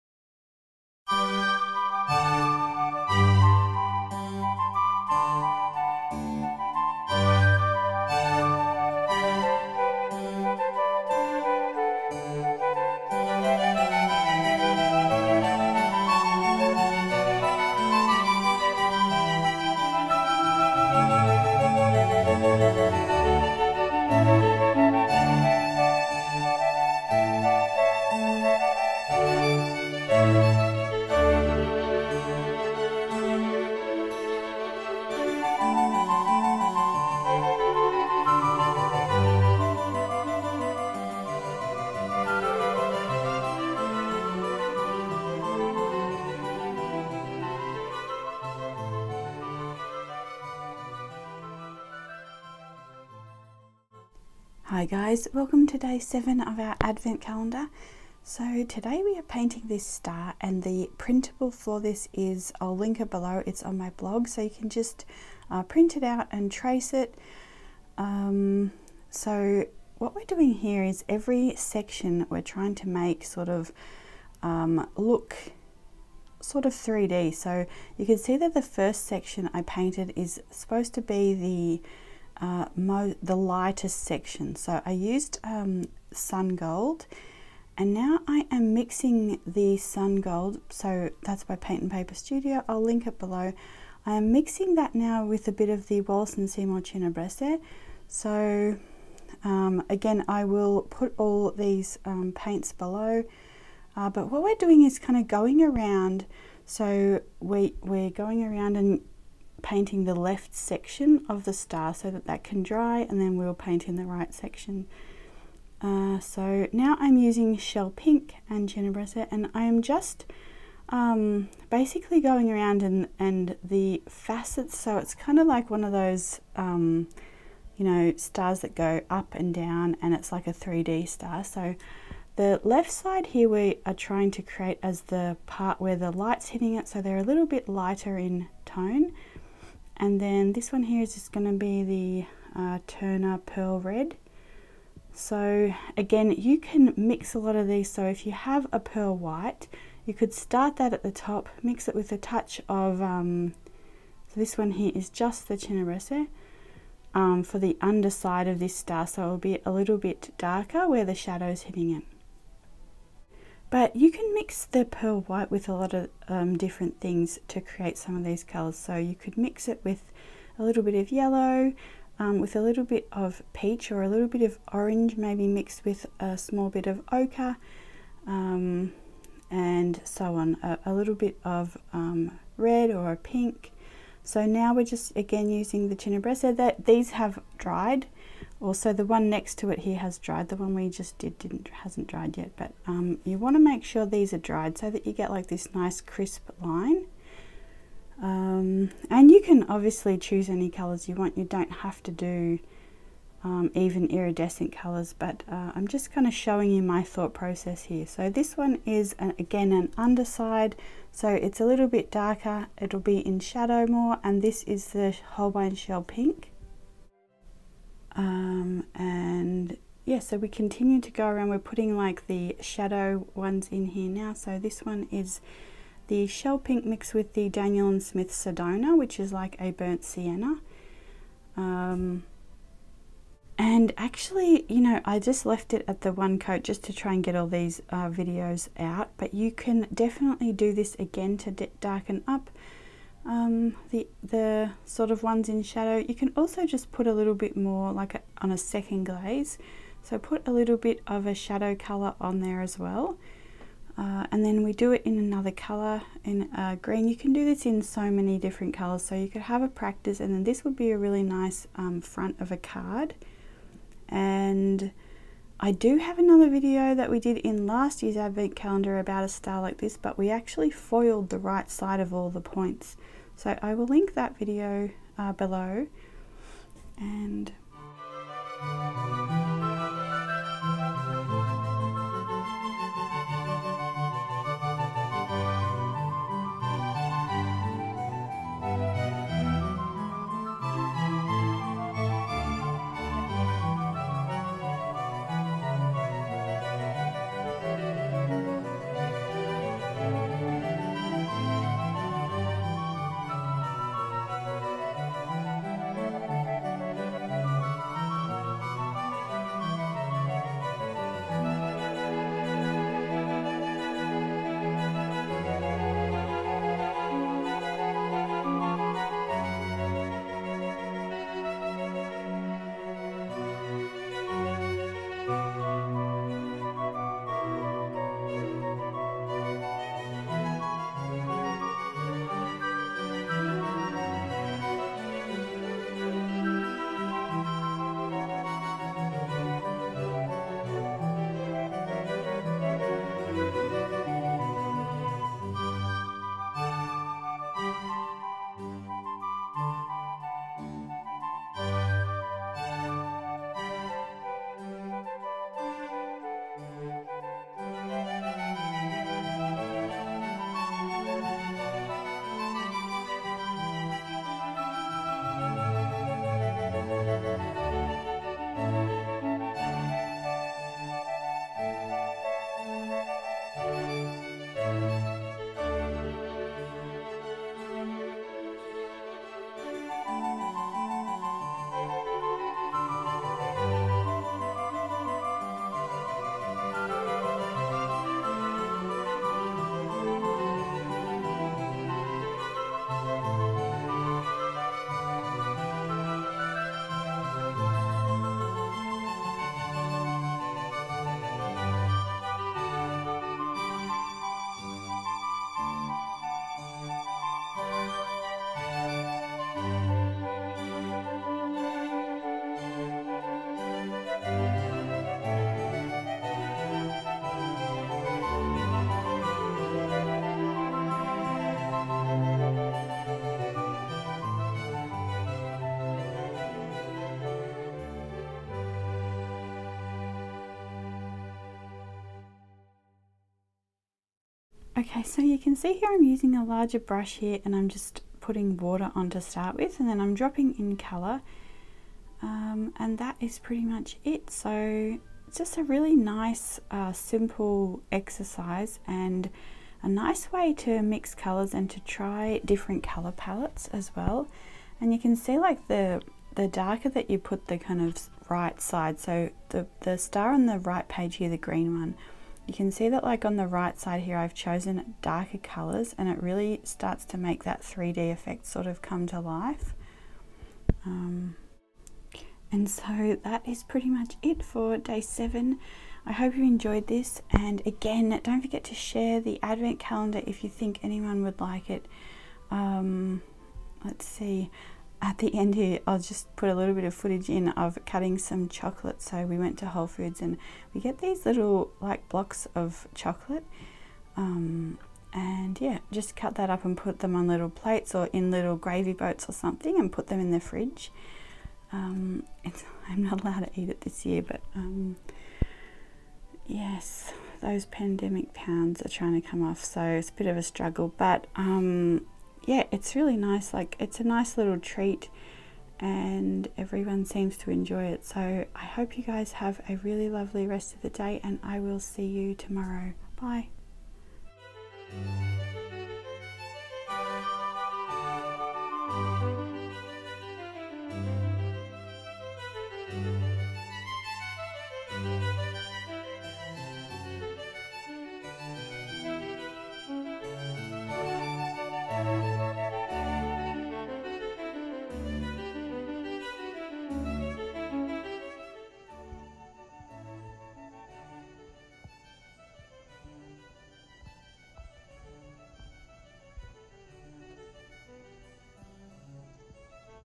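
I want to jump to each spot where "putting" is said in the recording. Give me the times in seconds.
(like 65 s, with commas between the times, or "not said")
221 s, 438 s.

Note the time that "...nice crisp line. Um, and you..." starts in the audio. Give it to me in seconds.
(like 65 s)
195 s.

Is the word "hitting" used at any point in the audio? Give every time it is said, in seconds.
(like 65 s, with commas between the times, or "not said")
136 s, 161 s.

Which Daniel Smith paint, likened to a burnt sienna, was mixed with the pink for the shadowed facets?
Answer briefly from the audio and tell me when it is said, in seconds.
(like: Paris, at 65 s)
Sedona, at 228 s.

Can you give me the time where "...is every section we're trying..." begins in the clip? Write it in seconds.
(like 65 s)
70 s.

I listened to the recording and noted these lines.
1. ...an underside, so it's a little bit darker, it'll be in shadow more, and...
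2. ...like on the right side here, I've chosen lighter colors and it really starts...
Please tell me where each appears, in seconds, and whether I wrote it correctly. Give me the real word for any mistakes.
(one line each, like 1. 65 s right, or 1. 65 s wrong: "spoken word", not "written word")
1. 209 s right
2. 463 s wrong: "darker", not "lighter".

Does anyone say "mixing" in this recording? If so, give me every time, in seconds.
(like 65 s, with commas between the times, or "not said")
88 s, 94 s.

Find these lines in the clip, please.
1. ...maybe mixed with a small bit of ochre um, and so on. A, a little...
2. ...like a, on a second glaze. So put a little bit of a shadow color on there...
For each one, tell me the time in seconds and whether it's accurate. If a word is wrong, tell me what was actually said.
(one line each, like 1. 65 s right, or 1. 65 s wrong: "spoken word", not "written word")
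1. 175 s right
2. 247 s right.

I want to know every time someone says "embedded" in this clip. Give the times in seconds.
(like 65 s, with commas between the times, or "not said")
not said.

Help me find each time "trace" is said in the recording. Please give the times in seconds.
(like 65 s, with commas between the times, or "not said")
66 s.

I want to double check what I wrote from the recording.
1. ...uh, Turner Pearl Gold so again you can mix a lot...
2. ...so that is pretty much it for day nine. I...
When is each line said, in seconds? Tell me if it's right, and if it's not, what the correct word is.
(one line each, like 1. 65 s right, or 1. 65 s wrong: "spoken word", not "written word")
1. 142 s wrong: "Red", not "Gold"
2. 472 s wrong: "seven", not "nine".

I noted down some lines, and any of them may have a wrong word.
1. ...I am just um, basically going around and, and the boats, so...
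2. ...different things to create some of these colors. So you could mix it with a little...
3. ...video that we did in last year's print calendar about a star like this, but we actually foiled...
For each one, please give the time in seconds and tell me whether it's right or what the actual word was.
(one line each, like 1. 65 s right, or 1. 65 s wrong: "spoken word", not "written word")
1. 119 s wrong: "facets", not "boats"
2. 166 s right
3. 266 s wrong: "advent", not "print".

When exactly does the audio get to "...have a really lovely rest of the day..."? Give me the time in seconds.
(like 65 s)
519 s.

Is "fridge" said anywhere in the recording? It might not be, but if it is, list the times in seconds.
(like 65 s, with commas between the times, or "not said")
500 s.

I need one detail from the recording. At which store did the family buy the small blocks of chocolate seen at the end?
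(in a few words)
Whole Foods.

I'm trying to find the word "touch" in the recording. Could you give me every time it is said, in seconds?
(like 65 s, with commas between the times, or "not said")
152 s.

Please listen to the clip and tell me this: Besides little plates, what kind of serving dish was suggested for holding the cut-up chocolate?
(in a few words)
Gravy boats.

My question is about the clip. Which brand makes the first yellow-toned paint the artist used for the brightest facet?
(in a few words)
Paint and Paper Studio.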